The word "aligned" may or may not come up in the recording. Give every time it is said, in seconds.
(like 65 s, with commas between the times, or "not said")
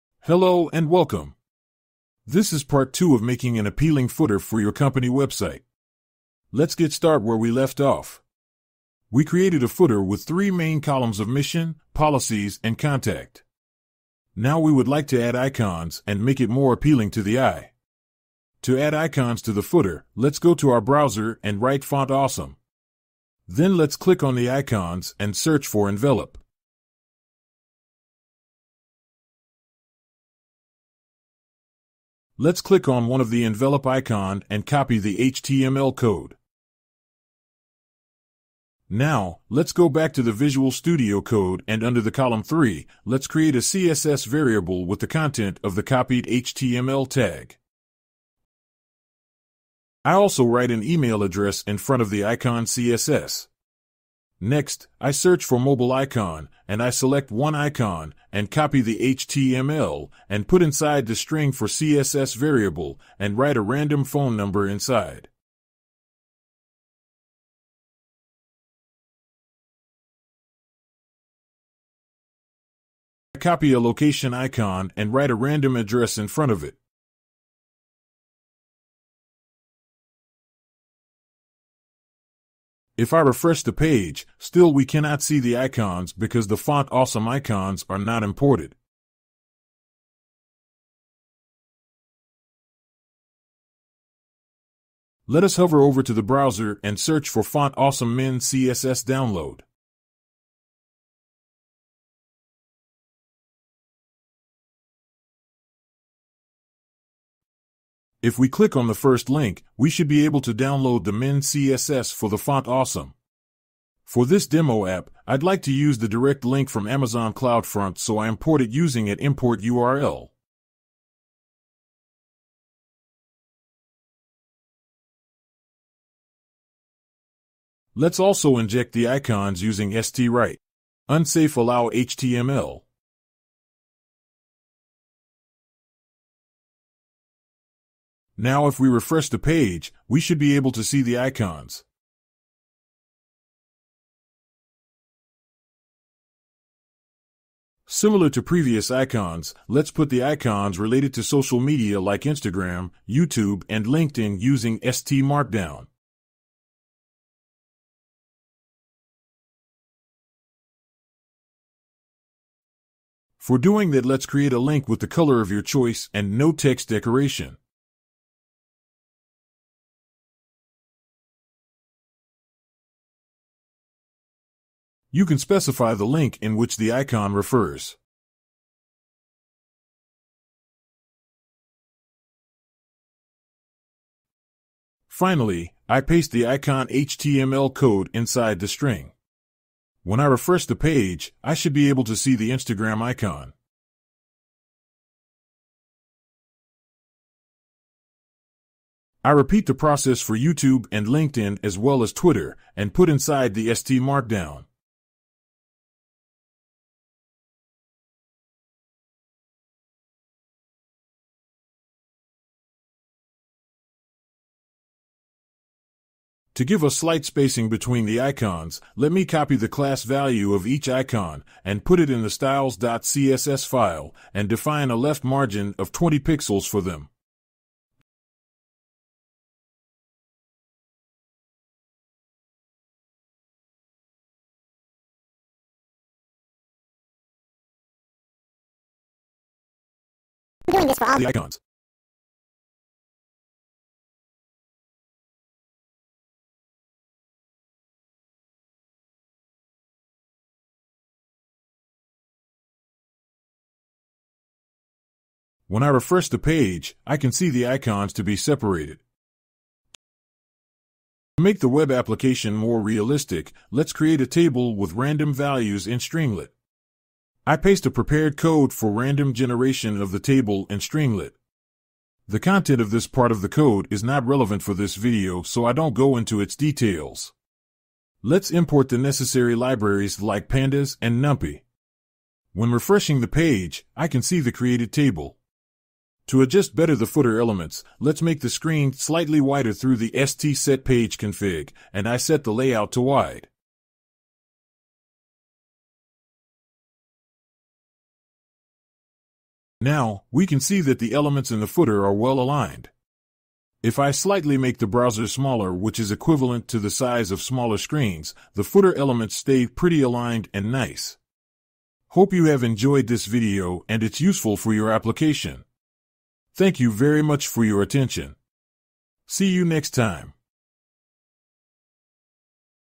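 302 s, 310 s.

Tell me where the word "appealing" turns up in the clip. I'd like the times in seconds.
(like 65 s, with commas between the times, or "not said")
3 s, 16 s.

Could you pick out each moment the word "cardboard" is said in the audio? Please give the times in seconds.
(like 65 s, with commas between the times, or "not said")
not said.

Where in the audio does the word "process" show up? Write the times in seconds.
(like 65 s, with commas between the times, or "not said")
199 s.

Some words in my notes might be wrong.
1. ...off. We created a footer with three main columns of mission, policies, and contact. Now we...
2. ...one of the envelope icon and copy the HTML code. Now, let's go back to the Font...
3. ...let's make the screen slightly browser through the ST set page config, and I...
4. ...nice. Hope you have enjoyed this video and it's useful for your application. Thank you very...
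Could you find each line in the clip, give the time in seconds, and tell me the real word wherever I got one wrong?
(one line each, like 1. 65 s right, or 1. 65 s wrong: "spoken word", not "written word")
1. 7 s right
2. 33 s wrong: "Visual", not "Font"
3. 287 s wrong: "wider", not "browser"
4. 310 s right.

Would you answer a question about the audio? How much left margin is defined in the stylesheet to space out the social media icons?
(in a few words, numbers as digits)
20 pixels.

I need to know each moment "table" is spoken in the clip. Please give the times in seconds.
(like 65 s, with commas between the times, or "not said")
264 s, 270 s, 284 s.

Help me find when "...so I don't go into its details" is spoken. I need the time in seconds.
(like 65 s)
275 s.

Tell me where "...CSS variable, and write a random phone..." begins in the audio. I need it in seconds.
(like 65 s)
61 s.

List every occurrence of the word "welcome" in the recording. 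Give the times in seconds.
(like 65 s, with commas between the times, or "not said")
0 s.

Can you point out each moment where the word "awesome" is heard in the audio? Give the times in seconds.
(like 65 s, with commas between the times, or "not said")
22 s, 86 s, 97 s, 112 s.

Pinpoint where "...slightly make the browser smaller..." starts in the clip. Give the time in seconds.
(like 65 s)
304 s.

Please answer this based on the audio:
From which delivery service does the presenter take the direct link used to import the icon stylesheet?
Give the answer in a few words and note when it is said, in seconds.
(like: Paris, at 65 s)
Amazon CloudFront, at 116 s.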